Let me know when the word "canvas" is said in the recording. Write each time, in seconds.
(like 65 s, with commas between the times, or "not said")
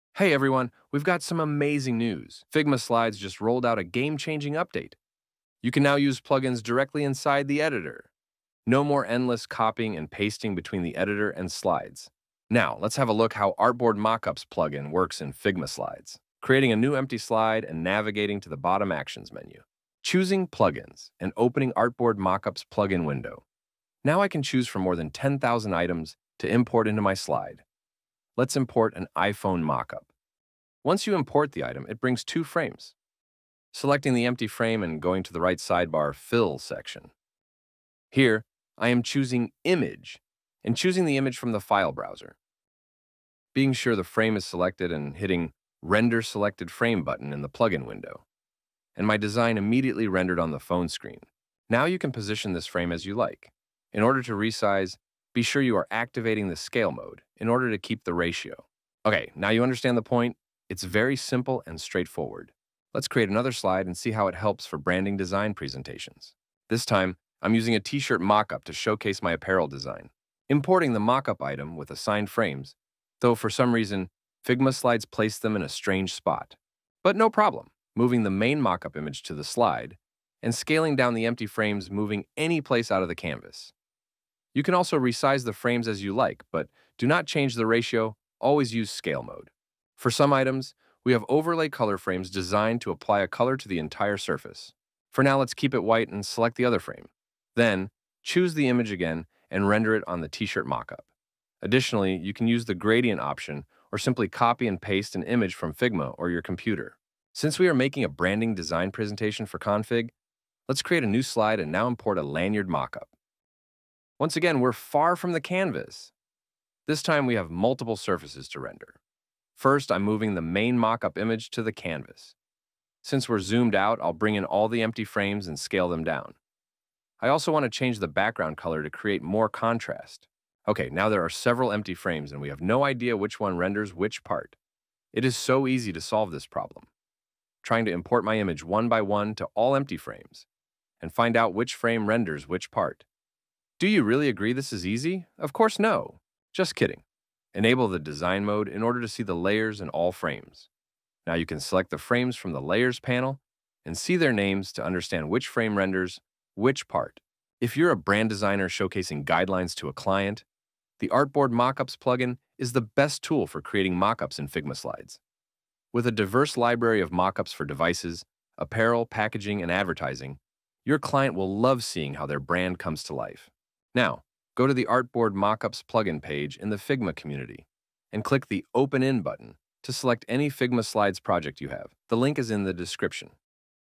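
83 s, 115 s, 121 s.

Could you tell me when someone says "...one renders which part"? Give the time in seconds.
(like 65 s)
133 s.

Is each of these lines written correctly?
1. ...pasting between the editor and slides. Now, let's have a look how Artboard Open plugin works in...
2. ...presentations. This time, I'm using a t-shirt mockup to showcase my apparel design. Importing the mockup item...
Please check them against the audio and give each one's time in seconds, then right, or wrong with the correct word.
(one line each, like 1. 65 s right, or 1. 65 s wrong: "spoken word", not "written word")
1. 10 s wrong: "Mockups", not "Open"
2. 65 s right.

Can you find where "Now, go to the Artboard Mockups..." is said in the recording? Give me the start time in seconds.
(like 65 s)
173 s.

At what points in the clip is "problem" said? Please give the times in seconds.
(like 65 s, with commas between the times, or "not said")
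77 s, 136 s.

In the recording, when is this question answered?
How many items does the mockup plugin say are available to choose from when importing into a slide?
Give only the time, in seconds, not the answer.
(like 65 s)
25 s.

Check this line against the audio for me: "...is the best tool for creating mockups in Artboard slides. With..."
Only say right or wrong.
wrong.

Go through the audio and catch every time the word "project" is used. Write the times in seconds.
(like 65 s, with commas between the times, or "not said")
181 s.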